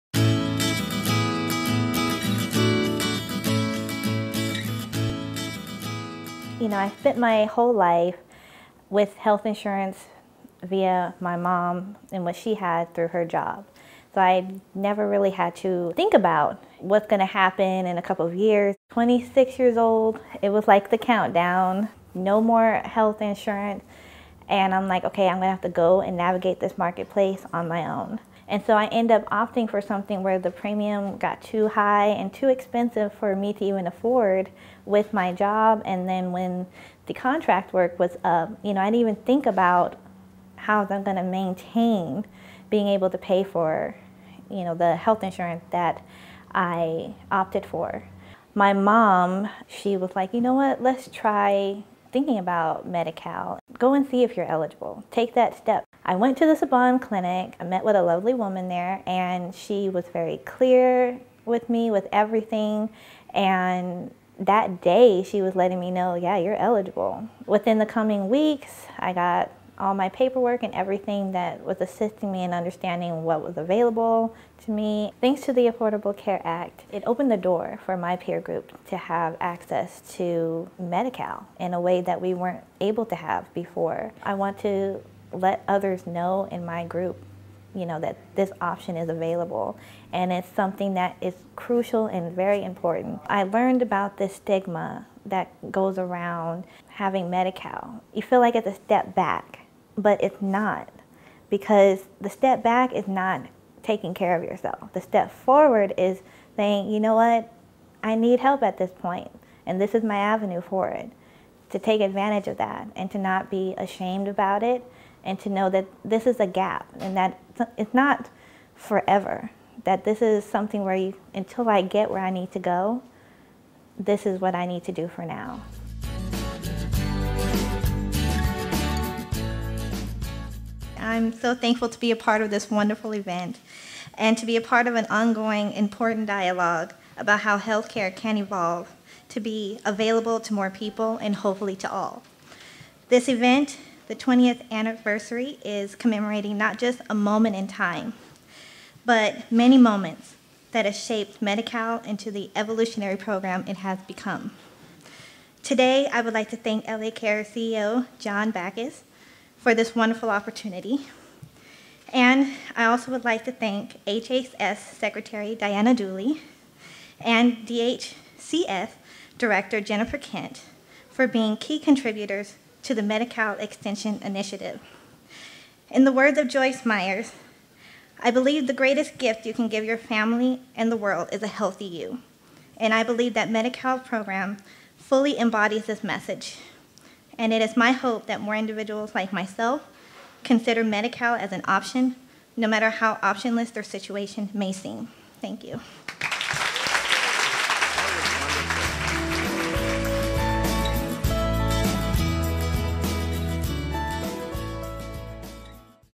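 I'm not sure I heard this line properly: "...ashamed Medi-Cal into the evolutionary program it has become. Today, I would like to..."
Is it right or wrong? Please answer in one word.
wrong.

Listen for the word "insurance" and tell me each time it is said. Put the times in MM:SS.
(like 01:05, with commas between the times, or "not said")
00:09, 00:23, 00:45.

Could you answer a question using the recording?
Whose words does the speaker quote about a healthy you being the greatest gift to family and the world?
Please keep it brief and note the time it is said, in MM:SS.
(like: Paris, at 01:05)
Joyce Myers, at 02:56.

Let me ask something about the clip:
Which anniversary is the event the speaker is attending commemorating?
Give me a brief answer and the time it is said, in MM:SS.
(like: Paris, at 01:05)
20th, at 02:24.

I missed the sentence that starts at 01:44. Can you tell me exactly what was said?
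The step forward is saying, you know what, I need help at this point, and this is my avenue for it.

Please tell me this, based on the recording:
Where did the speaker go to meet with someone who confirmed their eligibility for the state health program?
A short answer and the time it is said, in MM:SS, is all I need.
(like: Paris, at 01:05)
Saban clinic, at 00:56.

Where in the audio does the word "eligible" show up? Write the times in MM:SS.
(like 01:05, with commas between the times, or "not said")
00:54, 01:06.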